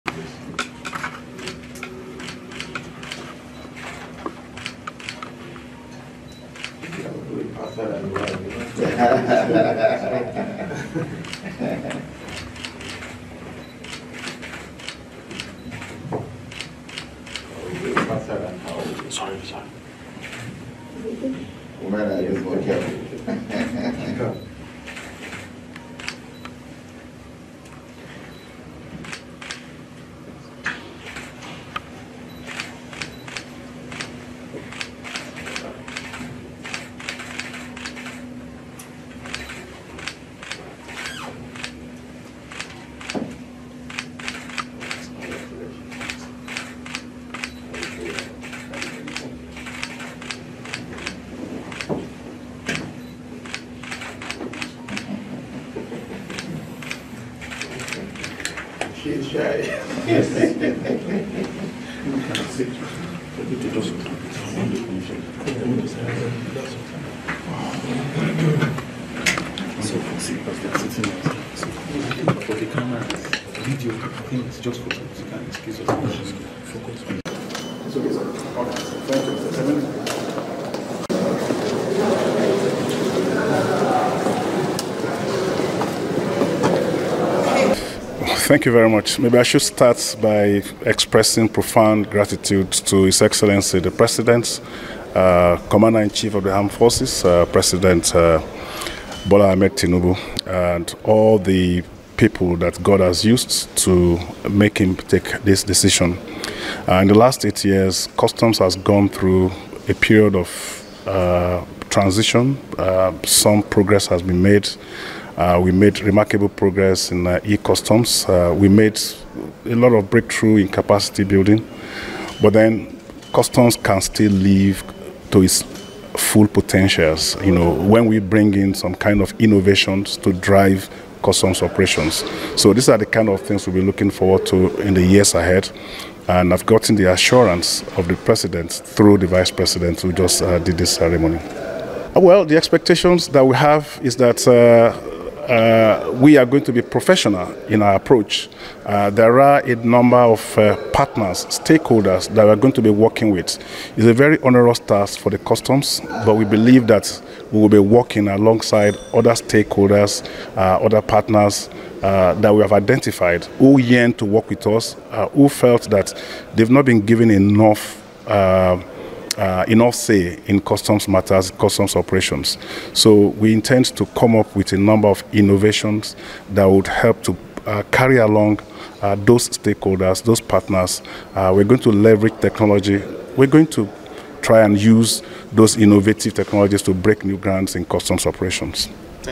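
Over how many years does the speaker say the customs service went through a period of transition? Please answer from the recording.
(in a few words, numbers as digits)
8.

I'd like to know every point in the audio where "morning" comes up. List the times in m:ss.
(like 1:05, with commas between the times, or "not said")
not said.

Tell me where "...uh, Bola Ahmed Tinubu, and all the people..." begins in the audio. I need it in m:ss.
1:38.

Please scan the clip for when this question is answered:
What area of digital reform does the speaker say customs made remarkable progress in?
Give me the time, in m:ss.
1:57.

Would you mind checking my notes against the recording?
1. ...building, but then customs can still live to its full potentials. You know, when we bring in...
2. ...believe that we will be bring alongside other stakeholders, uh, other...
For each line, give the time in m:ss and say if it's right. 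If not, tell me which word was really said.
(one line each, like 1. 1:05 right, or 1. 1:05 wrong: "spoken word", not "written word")
1. 2:01 right
2. 2:36 wrong: "working", not "bring".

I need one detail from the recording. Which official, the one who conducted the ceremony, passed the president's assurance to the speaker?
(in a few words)
The vice president.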